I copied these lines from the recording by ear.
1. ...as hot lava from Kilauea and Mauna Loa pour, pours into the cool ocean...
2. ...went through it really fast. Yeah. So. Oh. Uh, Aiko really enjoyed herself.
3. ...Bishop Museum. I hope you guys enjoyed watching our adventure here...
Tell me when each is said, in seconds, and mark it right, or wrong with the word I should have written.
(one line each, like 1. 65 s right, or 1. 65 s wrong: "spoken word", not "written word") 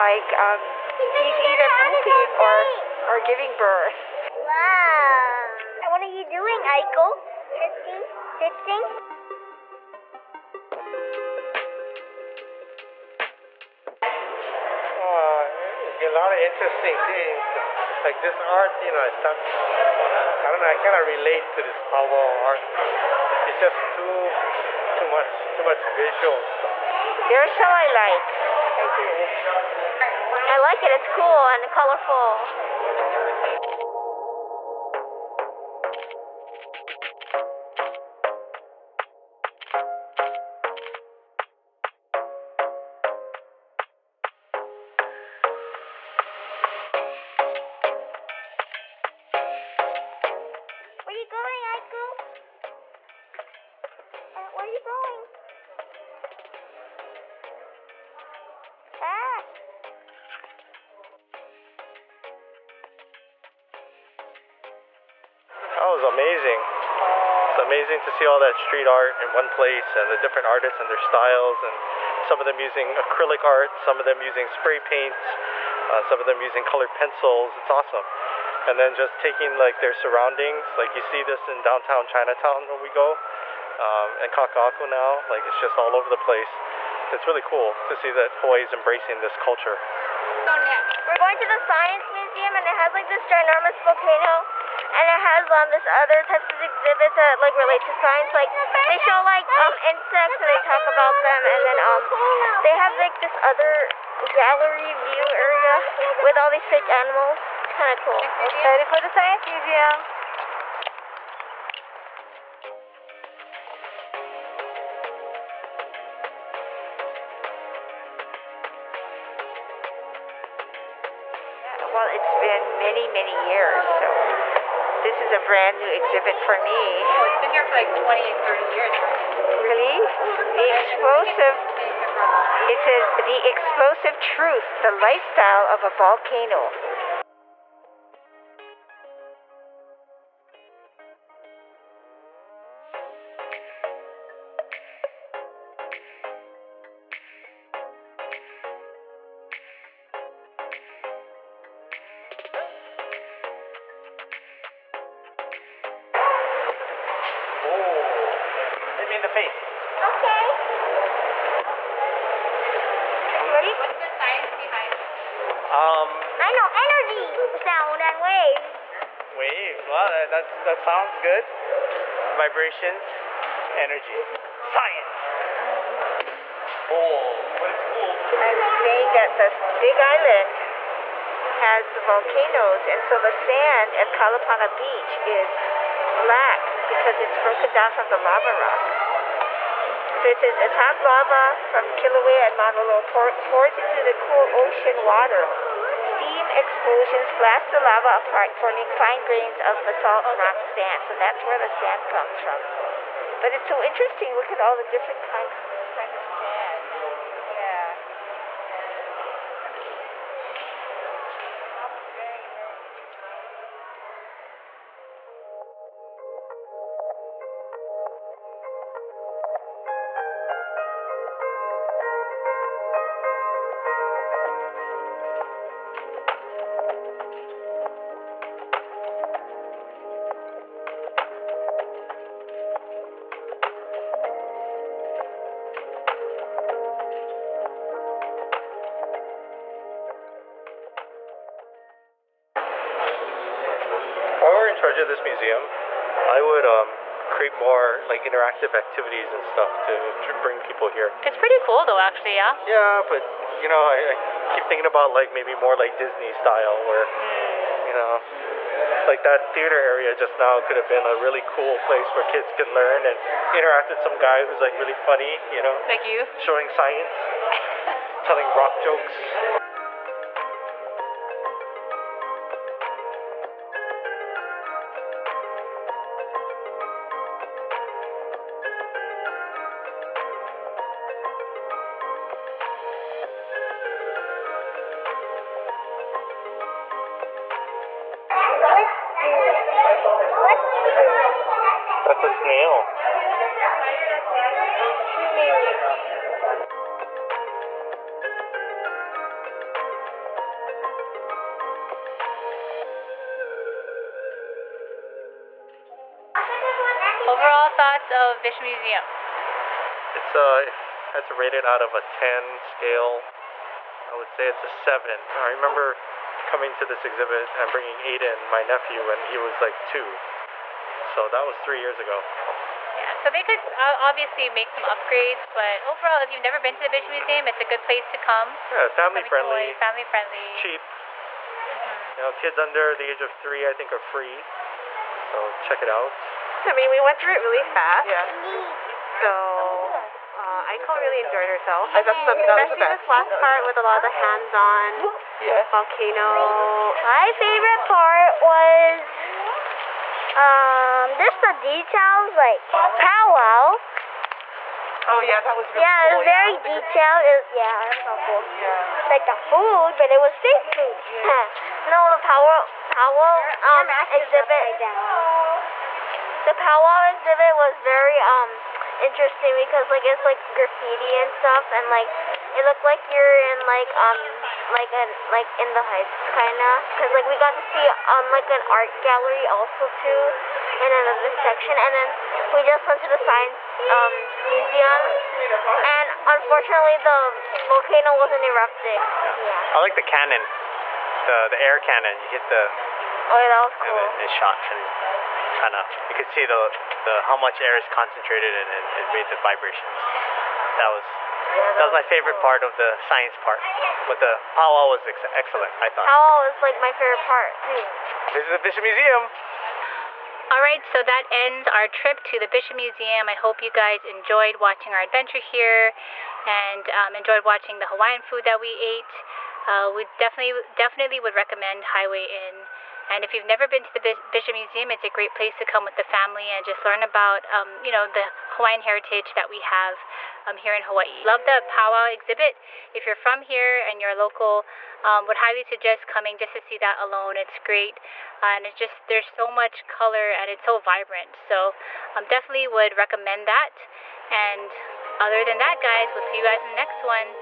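1. 190 s right
2. 336 s right
3. 412 s right.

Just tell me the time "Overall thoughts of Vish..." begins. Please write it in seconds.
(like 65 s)
307 s.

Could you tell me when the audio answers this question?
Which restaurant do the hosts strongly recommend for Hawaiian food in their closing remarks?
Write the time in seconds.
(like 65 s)
421 s.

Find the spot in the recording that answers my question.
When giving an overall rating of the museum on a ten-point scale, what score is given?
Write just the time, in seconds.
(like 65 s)
314 s.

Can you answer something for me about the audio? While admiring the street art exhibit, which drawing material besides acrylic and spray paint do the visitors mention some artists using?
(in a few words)
colored pencils.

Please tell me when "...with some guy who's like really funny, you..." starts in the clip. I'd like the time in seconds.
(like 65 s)
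263 s.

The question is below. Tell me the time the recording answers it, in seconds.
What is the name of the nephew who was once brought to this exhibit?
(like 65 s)
317 s.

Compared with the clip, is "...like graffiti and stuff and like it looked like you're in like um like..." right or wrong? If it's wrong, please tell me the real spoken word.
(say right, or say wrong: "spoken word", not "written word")
right.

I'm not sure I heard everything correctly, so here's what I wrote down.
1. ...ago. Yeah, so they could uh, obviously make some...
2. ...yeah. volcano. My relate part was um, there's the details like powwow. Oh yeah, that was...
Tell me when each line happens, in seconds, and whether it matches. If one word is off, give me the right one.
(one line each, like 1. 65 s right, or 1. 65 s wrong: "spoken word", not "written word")
1. 321 s right
2. 345 s wrong: "favorite", not "relate".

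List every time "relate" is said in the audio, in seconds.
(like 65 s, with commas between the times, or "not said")
21 s, 97 s.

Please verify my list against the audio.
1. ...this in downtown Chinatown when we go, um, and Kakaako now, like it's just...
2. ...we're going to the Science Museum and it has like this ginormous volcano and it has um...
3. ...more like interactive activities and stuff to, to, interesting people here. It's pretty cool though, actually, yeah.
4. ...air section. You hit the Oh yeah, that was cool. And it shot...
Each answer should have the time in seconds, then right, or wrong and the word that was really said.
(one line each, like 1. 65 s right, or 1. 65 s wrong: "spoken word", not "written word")
1. 81 s right
2. 91 s right
3. 247 s wrong: "bring", not "interesting"
4. 391 s wrong: "cannon", not "section".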